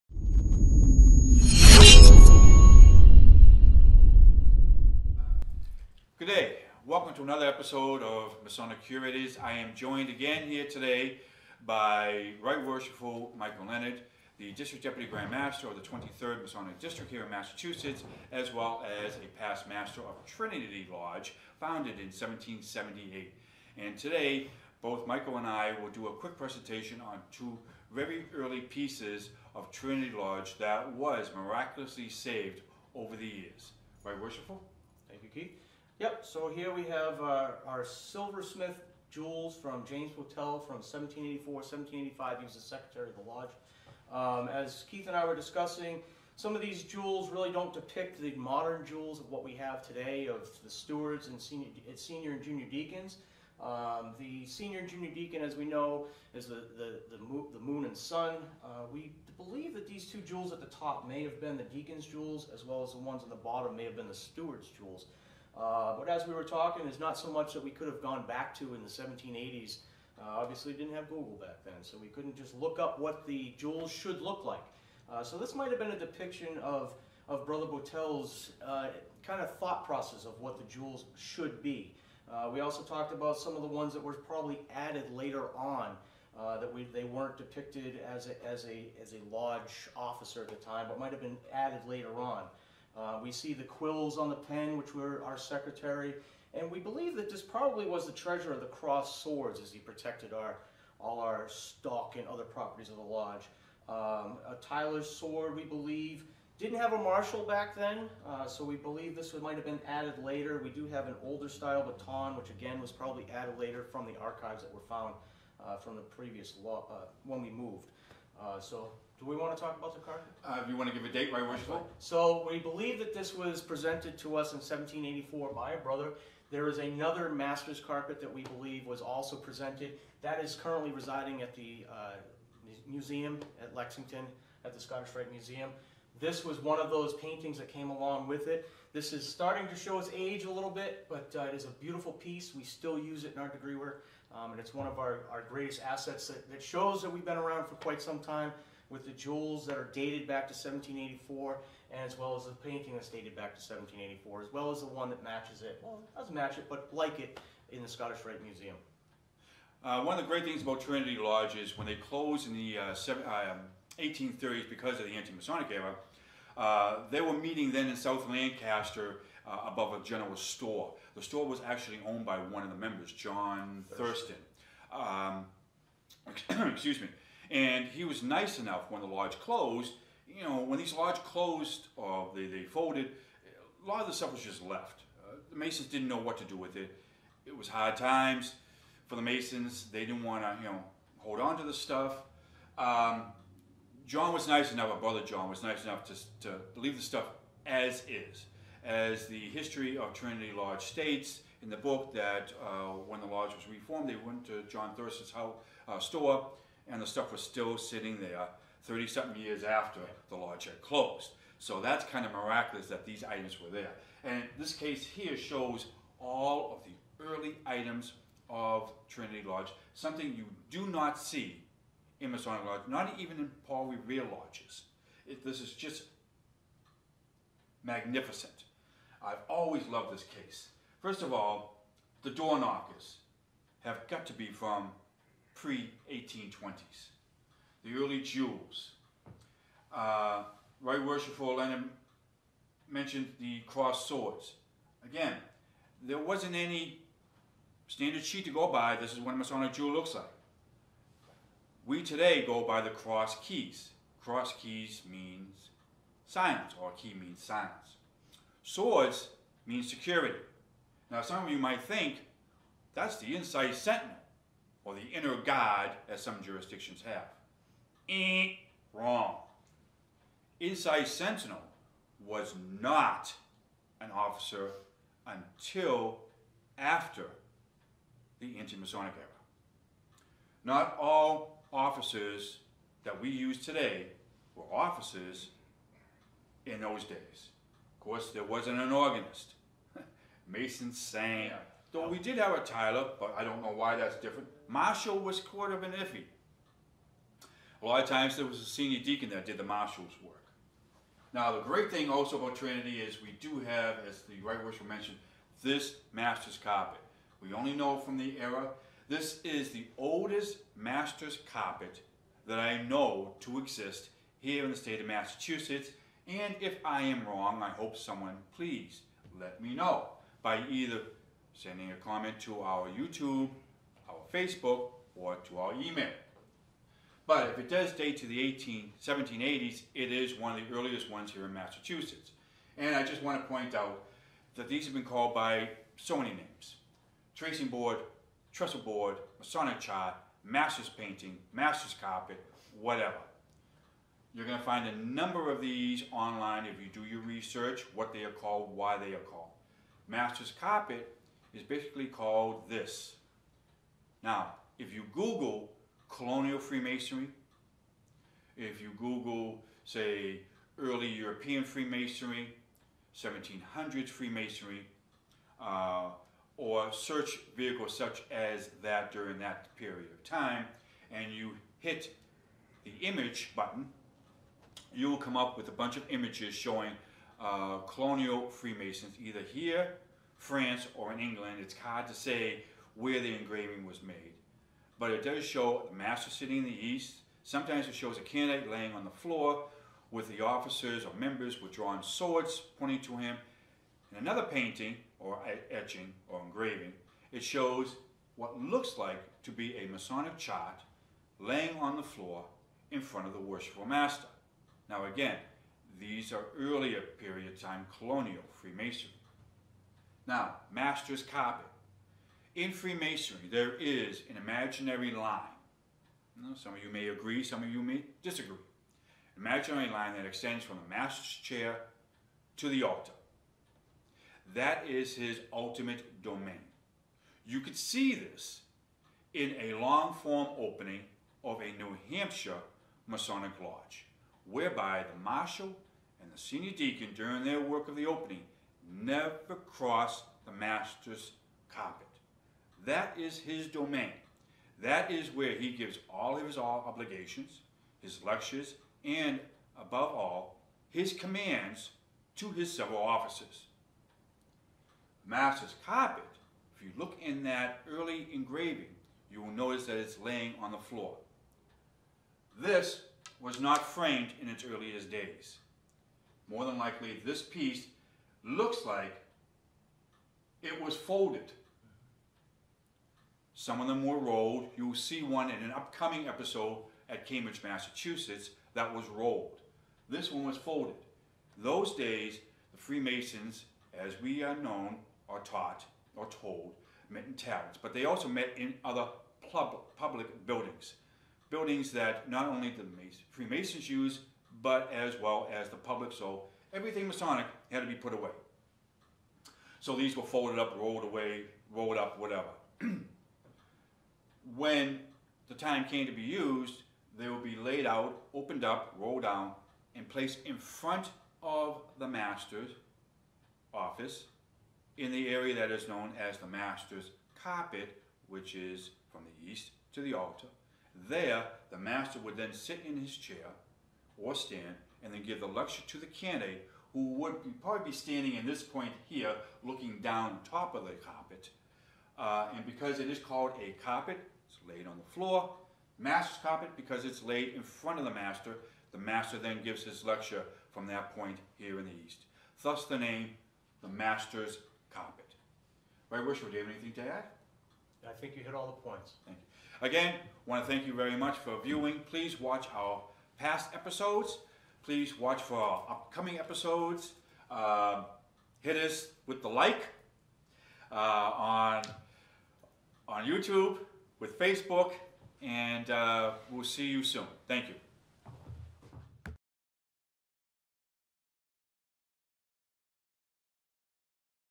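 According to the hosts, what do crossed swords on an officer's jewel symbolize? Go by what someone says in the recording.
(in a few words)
security.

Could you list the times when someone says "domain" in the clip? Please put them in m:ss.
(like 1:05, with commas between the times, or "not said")
7:06, 7:23.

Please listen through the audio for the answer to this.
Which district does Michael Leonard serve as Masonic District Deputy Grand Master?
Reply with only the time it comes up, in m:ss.
0:15.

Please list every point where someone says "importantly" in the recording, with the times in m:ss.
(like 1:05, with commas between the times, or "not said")
not said.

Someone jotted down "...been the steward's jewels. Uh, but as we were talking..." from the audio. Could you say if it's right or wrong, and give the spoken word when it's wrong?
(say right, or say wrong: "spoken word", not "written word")
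right.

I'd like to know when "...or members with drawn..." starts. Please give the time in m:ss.
6:31.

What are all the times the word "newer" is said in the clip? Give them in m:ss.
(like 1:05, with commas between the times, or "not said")
not said.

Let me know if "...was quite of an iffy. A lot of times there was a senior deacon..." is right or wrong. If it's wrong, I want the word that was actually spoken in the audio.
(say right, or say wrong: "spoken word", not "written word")
right.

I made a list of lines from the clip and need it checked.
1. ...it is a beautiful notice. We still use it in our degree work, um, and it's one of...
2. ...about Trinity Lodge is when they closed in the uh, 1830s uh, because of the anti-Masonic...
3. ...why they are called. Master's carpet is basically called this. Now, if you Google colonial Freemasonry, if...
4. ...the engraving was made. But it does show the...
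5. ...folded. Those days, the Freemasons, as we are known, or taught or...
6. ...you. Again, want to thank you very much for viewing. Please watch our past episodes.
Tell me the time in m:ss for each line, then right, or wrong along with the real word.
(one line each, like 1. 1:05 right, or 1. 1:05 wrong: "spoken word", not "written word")
1. 2:21 wrong: "piece", not "notice"
2. 2:40 right
3. 5:48 right
4. 6:23 right
5. 8:00 right
6. 9:09 right.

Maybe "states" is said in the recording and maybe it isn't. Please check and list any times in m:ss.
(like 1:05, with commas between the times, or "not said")
3:20, 5:14.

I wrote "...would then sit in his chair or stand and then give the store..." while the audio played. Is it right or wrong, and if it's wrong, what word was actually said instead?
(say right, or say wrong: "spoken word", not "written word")
wrong: "lecture", not "store".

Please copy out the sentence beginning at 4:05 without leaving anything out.
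Again, there wasn't any standard sheet to go by.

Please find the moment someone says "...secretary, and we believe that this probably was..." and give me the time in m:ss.
1:35.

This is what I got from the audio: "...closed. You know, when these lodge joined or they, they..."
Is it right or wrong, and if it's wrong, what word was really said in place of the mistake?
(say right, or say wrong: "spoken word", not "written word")
wrong: "closed", not "joined".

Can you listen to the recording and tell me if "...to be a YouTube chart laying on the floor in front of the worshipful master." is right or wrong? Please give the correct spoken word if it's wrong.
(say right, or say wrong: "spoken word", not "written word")
wrong: "Masonic", not "YouTube".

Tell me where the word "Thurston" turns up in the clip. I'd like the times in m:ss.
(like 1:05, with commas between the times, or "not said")
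2:53, 3:24.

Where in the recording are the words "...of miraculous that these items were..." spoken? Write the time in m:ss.
3:32.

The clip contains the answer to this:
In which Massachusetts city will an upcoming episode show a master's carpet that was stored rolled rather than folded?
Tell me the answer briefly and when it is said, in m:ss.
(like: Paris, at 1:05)
Cambridge, at 7:57.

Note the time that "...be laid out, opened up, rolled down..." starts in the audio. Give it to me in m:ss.
8:27.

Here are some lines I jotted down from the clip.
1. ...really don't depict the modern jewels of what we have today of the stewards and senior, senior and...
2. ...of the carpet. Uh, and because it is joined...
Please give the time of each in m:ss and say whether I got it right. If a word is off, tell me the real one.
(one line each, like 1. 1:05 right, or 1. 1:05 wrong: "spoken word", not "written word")
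1. 0:47 right
2. 8:50 wrong: "called", not "joined".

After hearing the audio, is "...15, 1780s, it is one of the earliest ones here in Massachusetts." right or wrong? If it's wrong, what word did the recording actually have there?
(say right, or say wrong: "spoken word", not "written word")
wrong: "18", not "15".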